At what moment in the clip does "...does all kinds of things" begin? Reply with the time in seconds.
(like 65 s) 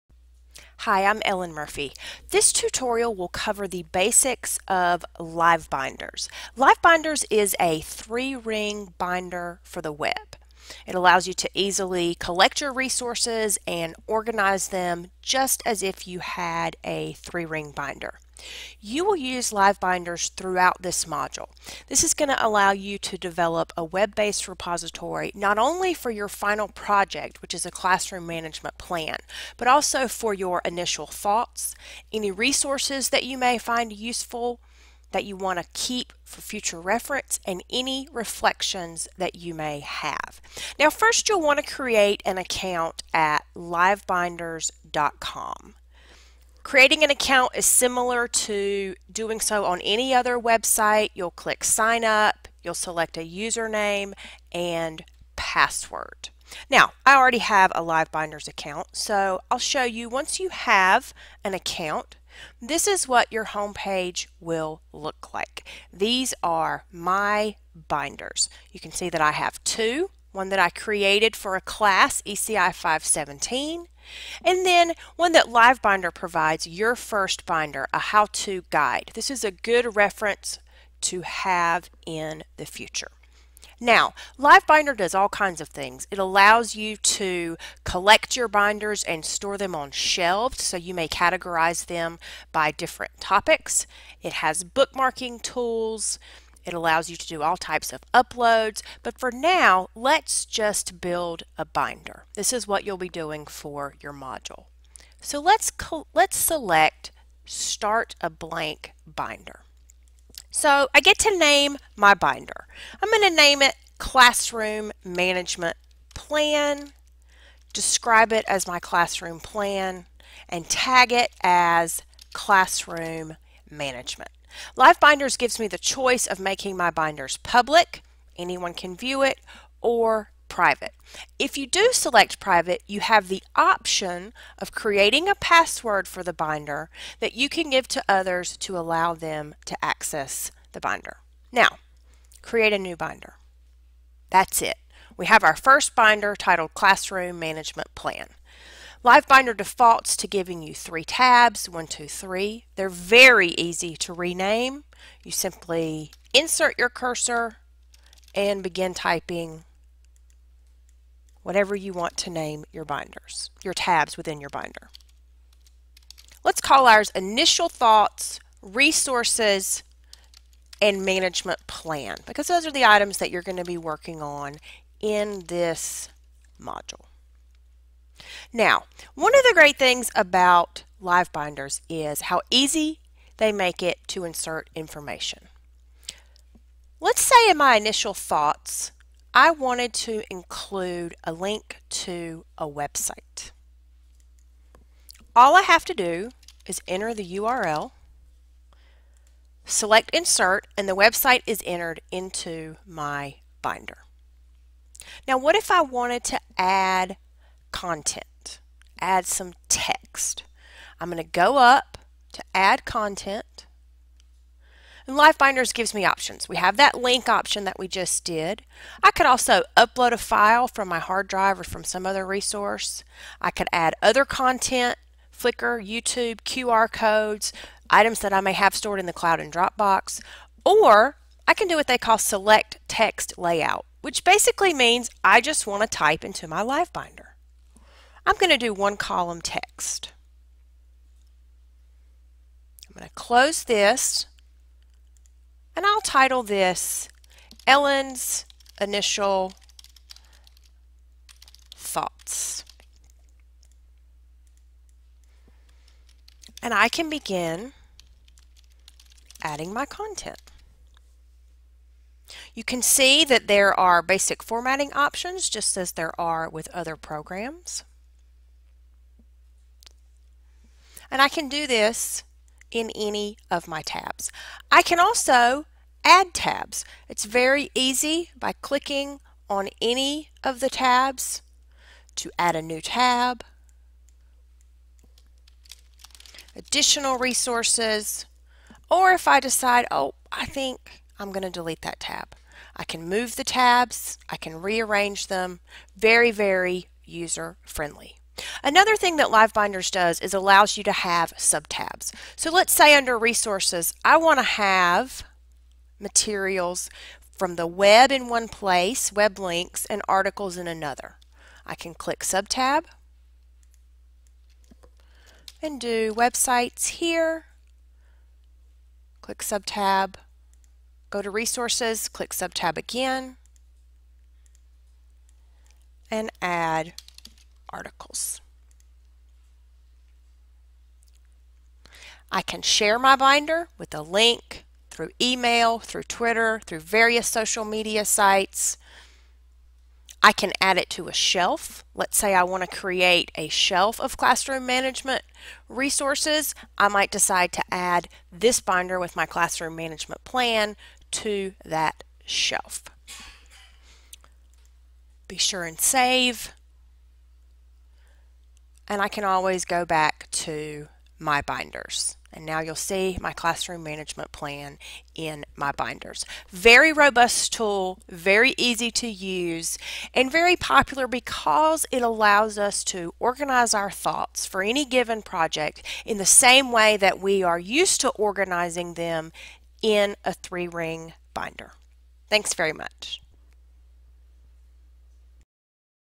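84 s.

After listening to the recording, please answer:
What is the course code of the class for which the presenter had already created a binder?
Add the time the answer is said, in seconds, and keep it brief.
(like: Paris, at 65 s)
ECI 517, at 72 s.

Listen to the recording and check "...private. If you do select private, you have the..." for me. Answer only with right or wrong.
right.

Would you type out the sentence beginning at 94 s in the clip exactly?
It has bookmarking tools, it allows you to do all types of uploads, but for now, let's just build a binder.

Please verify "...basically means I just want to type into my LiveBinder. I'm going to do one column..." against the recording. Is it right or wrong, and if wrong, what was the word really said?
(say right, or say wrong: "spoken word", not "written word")
right.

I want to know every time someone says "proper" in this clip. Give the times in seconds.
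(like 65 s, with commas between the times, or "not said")
not said.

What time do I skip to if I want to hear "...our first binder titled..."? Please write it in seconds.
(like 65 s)
145 s.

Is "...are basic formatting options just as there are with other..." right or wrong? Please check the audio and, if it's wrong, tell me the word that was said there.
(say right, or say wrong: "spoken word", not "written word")
right.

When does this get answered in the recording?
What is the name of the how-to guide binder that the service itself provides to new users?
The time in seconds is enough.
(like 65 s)
76 s.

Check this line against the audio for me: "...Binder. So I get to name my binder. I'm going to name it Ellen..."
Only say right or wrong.
wrong.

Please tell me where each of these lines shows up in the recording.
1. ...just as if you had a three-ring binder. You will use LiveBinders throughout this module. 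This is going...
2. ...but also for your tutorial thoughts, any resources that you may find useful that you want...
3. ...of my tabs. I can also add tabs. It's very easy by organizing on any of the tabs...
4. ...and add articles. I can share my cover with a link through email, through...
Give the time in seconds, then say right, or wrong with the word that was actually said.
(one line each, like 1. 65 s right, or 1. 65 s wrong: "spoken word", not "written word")
1. 15 s right
2. 29 s wrong: "initial", not "tutorial"
3. 273 s wrong: "clicking", not "organizing"
4. 326 s wrong: "binder", not "cover".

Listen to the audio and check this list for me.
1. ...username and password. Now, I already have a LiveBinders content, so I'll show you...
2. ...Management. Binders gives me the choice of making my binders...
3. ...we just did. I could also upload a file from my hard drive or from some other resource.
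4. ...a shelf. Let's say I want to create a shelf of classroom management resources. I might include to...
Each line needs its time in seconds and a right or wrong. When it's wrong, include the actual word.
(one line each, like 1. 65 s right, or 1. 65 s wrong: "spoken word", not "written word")
1. 53 s wrong: "account", not "content"
2. 123 s right
3. 217 s right
4. 341 s wrong: "decide", not "include".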